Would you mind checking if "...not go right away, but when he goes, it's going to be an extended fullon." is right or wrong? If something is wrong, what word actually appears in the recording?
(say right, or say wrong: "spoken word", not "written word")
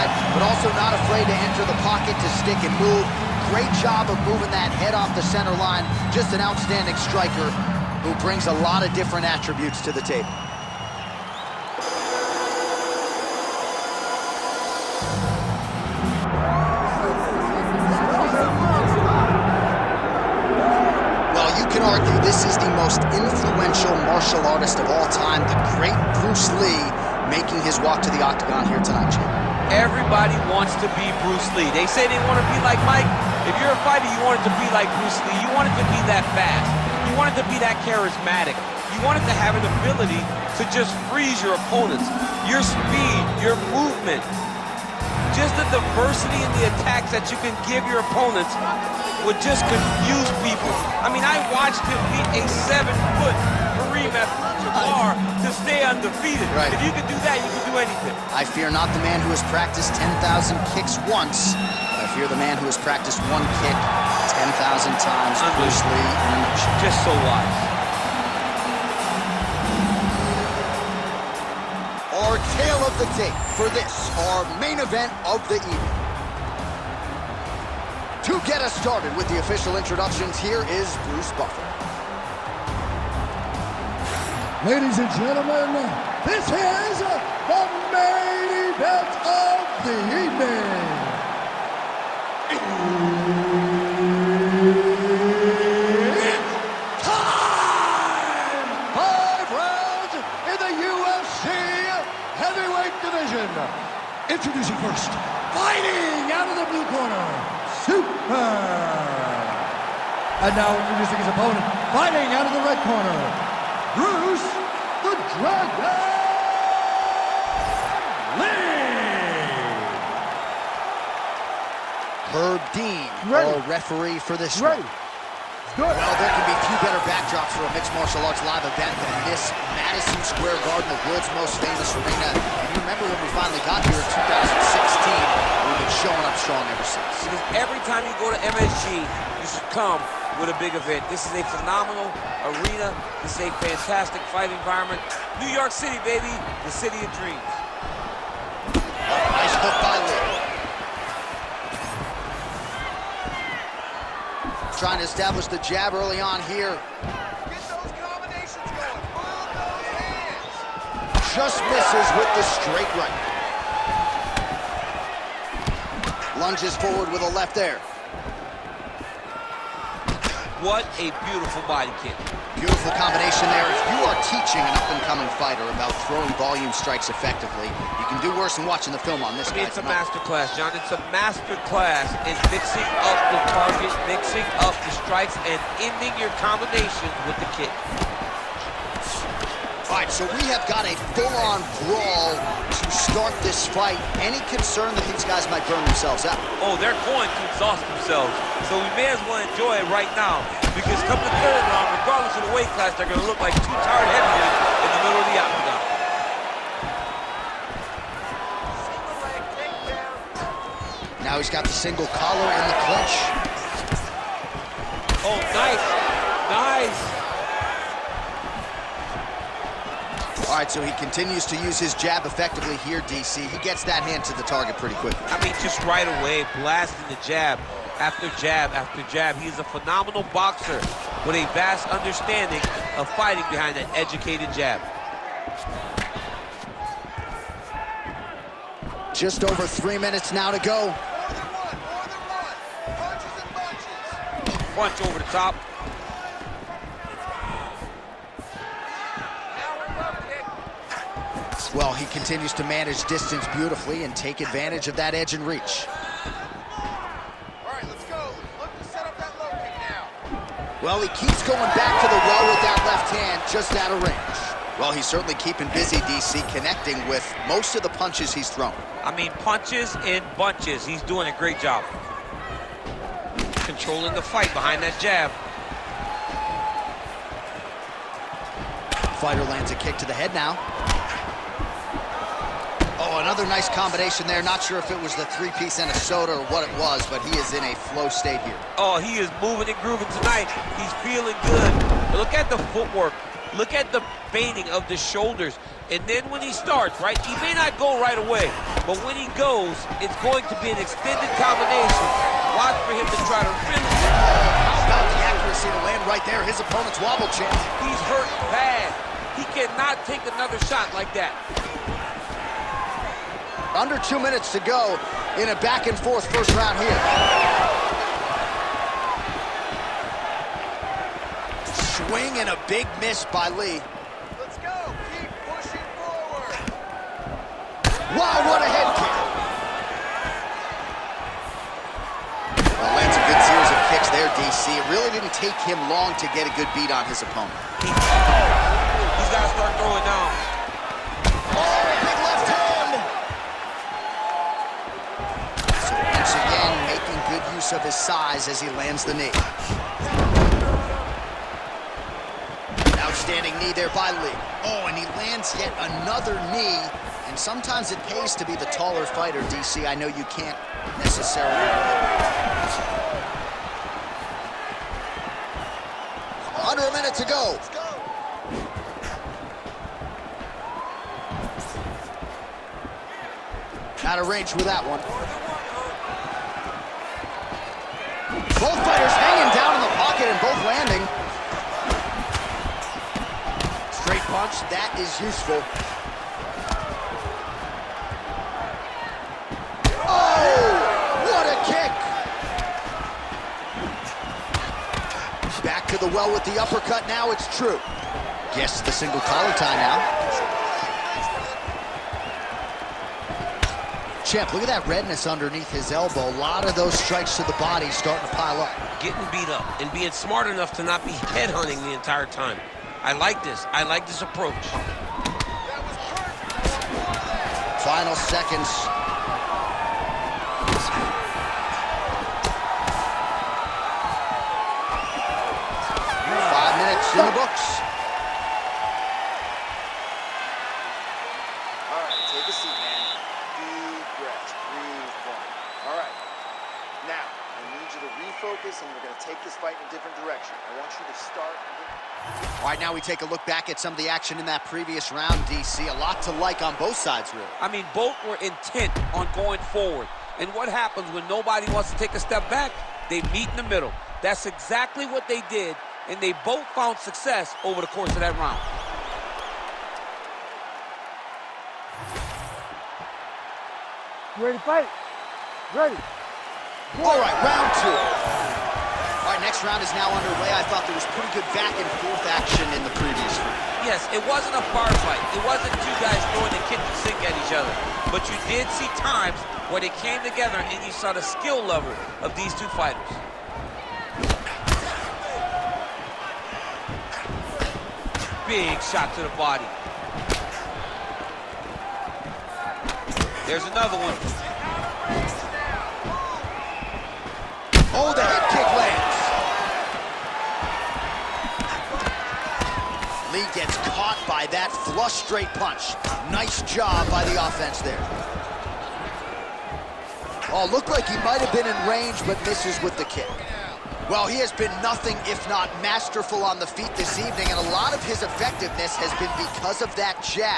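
wrong: "combination", not "fullon".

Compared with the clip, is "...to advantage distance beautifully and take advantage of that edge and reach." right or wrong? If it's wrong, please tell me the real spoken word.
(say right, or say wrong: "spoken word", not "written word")
wrong: "manage", not "advantage".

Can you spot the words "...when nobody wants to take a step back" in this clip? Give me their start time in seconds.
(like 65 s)
451 s.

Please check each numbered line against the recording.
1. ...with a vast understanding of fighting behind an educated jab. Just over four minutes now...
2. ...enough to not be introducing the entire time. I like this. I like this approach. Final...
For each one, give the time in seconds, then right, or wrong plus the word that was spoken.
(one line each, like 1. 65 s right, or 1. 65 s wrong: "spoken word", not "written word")
1. 231 s wrong: "three", not "four"
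2. 410 s wrong: "headhunting", not "introducing".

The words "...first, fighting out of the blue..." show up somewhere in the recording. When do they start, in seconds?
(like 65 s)
104 s.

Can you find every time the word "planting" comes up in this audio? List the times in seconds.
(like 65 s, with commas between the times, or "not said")
not said.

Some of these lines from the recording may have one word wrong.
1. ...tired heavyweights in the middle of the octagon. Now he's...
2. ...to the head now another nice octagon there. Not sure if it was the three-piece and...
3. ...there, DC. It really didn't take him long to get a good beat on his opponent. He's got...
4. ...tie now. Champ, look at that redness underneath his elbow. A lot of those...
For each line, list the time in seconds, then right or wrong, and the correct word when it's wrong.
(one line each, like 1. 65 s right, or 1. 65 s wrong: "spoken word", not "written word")
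1. 203 s right
2. 279 s wrong: "combination", not "octagon"
3. 334 s right
4. 399 s right.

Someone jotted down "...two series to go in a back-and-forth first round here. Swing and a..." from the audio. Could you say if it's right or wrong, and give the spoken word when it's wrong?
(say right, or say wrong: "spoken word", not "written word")
wrong: "minutes", not "series".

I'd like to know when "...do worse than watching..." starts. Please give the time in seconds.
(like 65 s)
178 s.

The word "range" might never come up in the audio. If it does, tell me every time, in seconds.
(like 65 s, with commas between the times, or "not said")
264 s, 374 s, 511 s.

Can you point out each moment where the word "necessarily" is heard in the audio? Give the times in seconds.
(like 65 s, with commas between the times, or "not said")
360 s.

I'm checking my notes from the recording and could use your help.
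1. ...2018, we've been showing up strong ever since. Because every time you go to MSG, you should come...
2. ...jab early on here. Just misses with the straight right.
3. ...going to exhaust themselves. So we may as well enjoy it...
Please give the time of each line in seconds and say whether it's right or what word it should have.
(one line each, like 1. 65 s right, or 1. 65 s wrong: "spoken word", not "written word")
1. 134 s wrong: "2016", not "2018"
2. 155 s right
3. 197 s right.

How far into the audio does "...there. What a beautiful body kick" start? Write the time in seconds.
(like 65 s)
167 s.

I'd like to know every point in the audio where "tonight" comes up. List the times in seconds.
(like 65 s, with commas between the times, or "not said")
179 s, 290 s.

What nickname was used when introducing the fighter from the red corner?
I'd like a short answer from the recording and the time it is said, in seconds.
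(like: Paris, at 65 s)
The Dragon, at 115 s.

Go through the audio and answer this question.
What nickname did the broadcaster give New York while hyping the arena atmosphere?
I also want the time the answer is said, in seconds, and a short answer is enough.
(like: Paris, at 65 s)
the city of dreams, at 146 s.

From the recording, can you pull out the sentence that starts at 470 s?
I thought there was pretty good back and forth action in the previous round.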